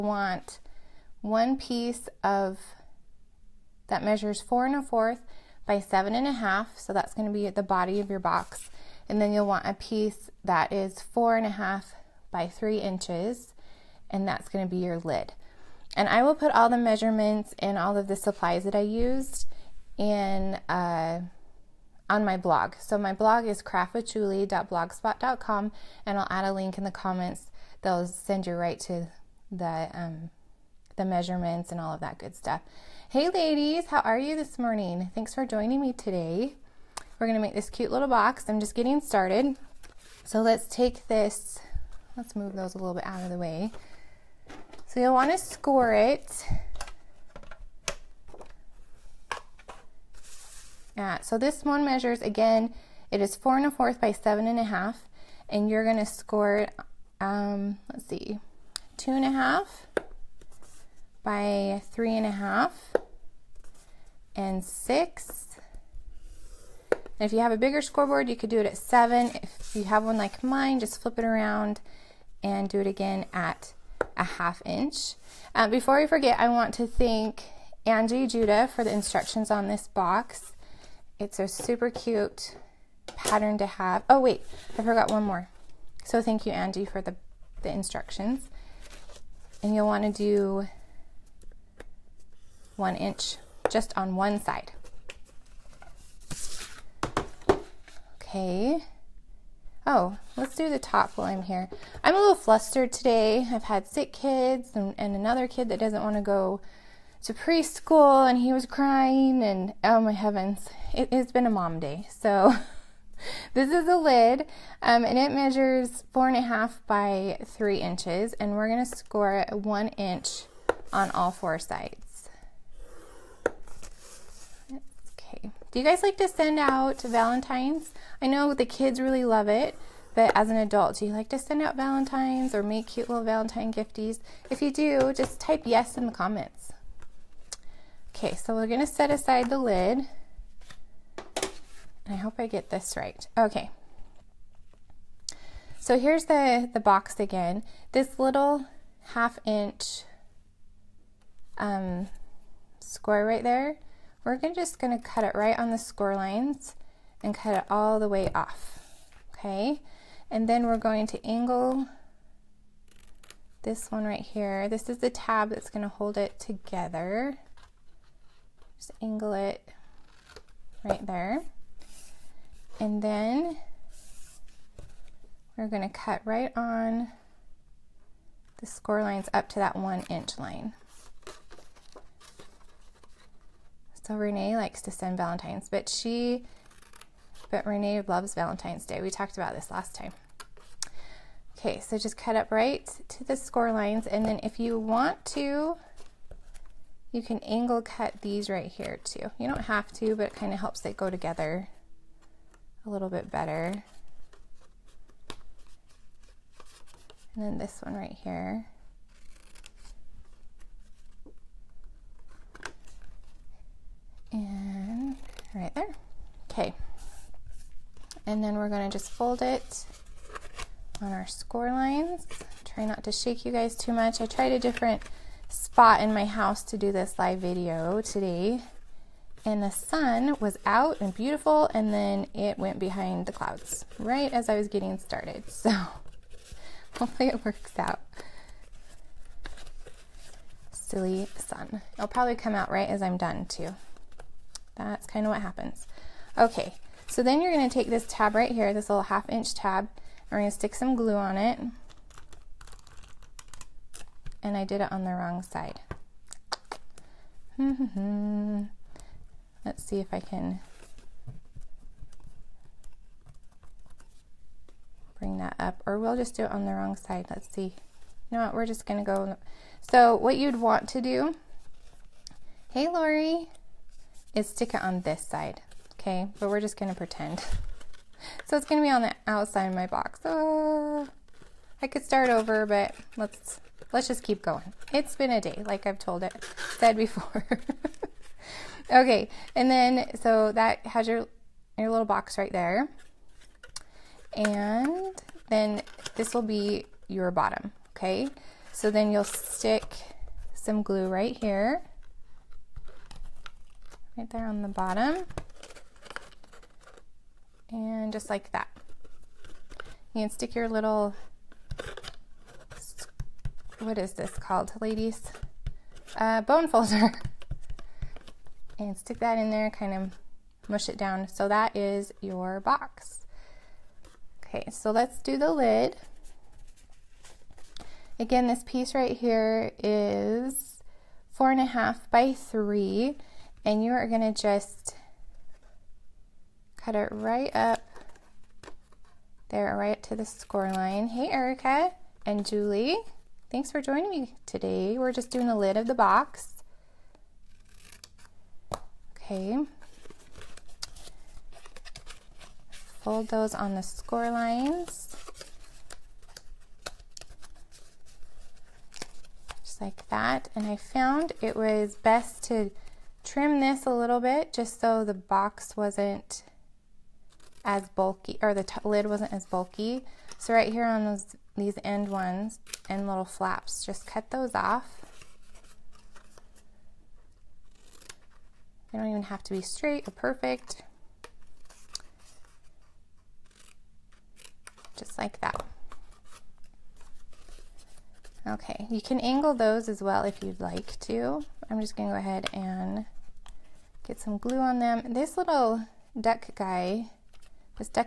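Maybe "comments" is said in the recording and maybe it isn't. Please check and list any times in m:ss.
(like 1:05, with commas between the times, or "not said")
0:26, 2:16.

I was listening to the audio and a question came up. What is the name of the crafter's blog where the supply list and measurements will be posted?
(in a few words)
craftwithjulie.blogspot.com.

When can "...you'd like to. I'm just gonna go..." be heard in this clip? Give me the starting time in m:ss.
6:30.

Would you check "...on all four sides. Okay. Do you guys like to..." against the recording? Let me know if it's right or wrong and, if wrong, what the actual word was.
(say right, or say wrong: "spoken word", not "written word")
right.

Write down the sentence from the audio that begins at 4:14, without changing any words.
And I did it on the wrong side.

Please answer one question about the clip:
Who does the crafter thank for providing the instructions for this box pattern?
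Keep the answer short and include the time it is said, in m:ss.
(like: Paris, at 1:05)
Angie Judah, at 1:17.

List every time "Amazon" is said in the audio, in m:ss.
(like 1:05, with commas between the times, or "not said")
not said.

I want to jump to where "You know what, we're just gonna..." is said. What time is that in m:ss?
4:28.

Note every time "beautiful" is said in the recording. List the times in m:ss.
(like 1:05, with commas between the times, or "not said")
3:51.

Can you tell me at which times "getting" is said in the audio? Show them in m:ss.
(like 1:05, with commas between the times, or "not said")
0:38, 3:54.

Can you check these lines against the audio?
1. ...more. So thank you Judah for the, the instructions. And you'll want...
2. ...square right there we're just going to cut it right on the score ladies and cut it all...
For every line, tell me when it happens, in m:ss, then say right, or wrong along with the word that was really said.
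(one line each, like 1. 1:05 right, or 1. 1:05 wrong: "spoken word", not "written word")
1. 1:25 wrong: "Angie", not "Judah"
2. 2:32 wrong: "lines", not "ladies".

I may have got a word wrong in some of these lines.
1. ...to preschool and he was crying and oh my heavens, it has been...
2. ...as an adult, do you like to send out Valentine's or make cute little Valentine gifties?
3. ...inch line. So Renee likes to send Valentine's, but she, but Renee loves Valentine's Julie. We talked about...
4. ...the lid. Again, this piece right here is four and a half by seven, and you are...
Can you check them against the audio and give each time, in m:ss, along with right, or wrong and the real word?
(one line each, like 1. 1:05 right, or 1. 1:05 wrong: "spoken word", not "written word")
1. 1:47 right
2. 2:10 right
3. 3:00 wrong: "Day", not "Julie"
4. 5:25 wrong: "three", not "seven".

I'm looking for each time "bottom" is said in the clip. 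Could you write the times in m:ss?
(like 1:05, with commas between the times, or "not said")
4:57, 5:04.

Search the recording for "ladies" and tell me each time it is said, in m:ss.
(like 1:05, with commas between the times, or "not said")
0:33, 5:14.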